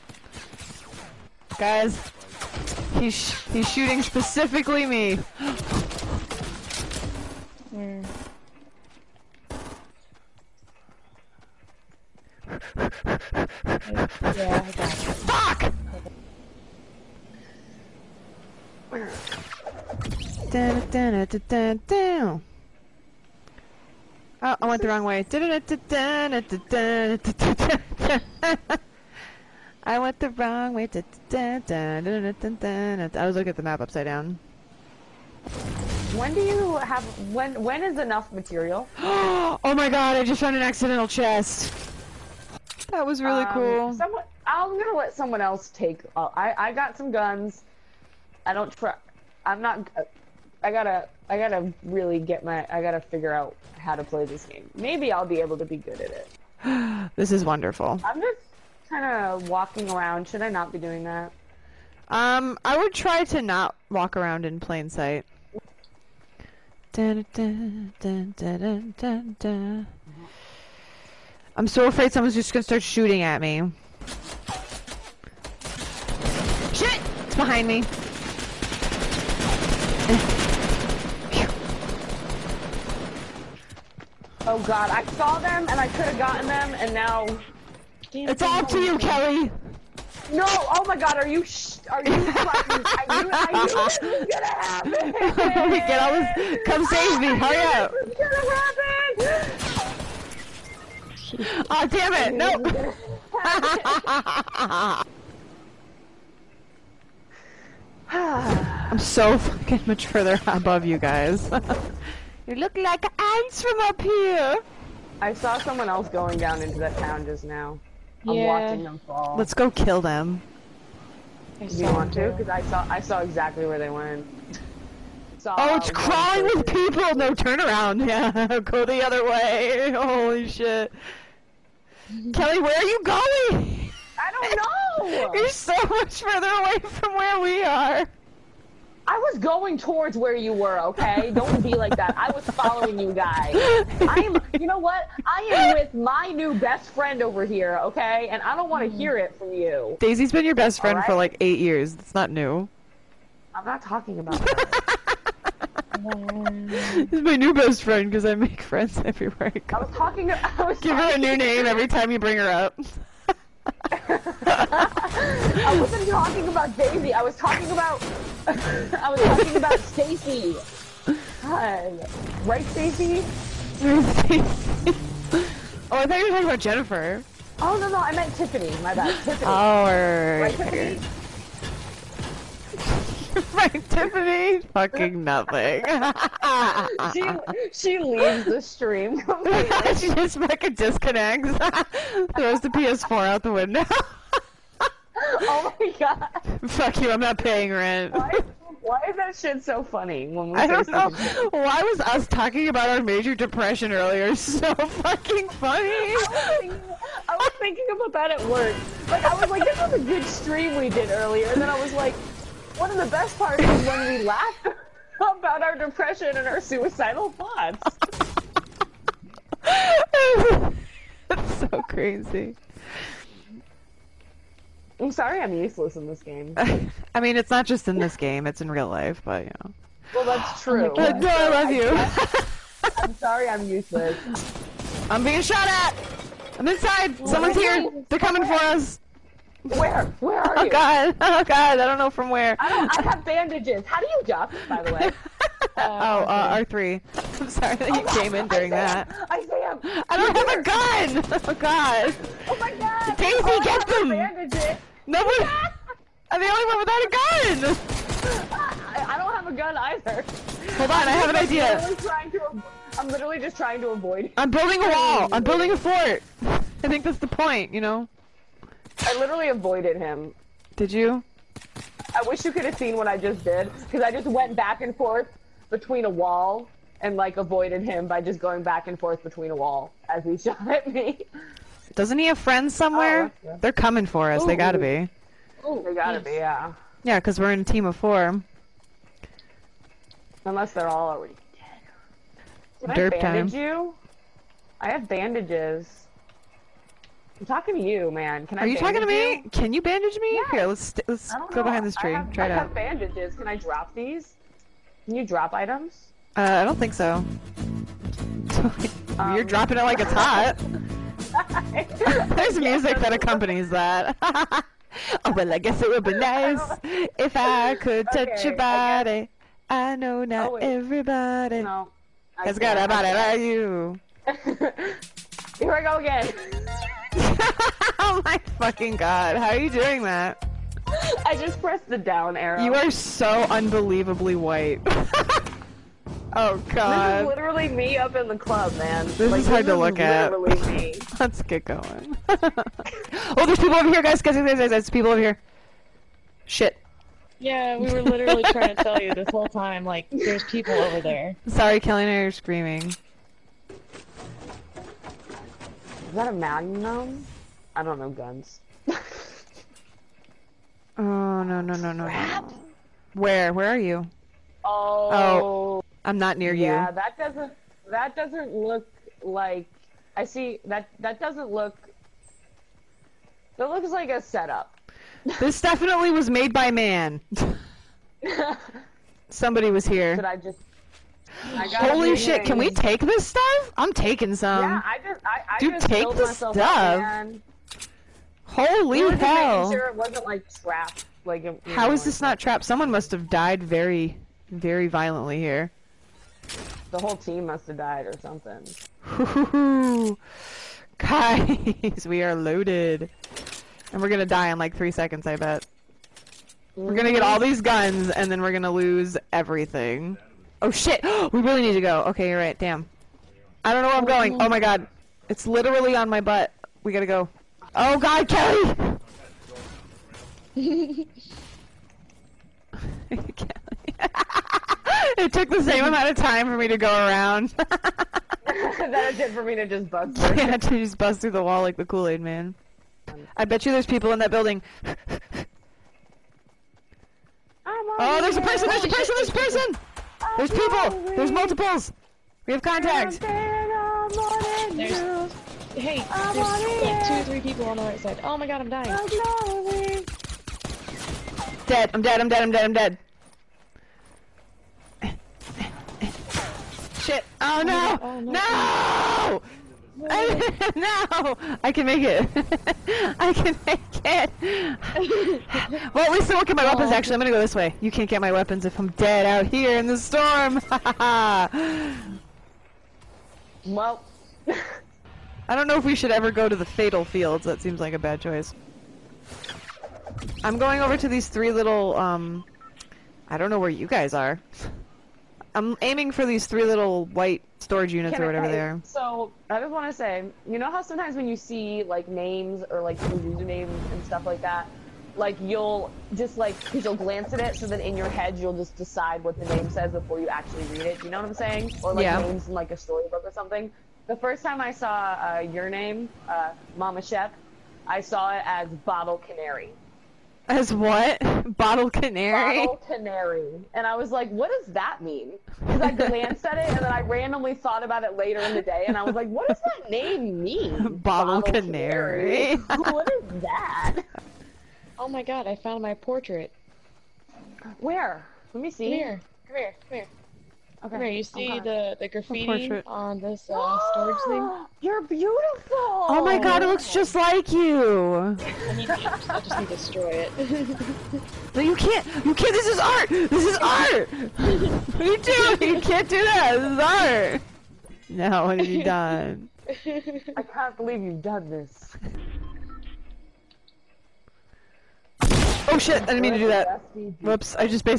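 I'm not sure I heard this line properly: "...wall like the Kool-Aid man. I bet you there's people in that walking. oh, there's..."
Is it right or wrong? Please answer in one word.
wrong.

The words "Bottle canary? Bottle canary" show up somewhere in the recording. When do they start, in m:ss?
8:31.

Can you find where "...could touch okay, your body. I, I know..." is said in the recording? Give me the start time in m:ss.
5:17.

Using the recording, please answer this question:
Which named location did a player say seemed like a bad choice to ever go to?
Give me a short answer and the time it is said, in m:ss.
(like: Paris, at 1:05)
Fatal Fields, at 7:56.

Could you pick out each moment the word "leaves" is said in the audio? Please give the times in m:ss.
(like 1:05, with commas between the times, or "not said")
3:07.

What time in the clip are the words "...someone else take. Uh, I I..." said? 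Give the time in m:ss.
0:45.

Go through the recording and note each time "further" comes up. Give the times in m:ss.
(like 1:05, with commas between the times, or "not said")
1:50, 2:16.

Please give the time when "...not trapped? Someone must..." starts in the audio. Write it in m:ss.
6:32.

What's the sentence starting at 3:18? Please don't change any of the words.
Why, why is that shit so funny when we I don't know.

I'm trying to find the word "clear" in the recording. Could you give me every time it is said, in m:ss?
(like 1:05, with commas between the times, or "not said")
not said.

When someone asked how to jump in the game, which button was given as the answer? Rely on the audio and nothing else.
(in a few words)
R3.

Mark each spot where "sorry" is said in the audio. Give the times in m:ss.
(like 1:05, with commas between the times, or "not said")
3:45, 3:53, 4:07, 5:51.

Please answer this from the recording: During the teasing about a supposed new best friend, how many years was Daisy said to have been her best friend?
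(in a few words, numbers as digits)
8.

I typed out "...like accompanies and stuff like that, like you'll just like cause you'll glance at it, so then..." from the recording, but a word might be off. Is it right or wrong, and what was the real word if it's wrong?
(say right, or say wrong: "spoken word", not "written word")
wrong: "usernames", not "accompanies".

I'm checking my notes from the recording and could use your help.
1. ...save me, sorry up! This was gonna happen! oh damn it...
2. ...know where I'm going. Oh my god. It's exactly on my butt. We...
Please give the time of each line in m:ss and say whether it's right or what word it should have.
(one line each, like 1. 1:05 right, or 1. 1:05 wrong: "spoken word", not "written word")
1. 1:36 wrong: "hurry", not "sorry"
2. 6:53 wrong: "literally", not "exactly".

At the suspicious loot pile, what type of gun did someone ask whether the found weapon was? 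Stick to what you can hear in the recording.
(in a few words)
Magnum.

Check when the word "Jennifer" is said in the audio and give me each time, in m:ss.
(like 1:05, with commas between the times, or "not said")
2:56.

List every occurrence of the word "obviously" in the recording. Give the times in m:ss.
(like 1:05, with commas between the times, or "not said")
not said.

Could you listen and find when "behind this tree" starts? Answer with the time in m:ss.
5:01.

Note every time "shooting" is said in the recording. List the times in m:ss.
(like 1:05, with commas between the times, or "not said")
0:03, 1:12.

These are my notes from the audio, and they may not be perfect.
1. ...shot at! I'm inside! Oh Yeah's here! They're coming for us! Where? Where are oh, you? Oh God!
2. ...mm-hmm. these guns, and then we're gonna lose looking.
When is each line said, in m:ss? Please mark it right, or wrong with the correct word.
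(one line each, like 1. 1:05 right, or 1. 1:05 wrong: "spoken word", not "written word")
1. 3:55 wrong: "Someone", not "Yeah"
2. 6:47 wrong: "everything", not "looking".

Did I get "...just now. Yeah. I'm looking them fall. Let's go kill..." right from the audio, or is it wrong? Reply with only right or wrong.
wrong.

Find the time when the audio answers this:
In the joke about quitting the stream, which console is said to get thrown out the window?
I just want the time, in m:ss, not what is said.
3:12.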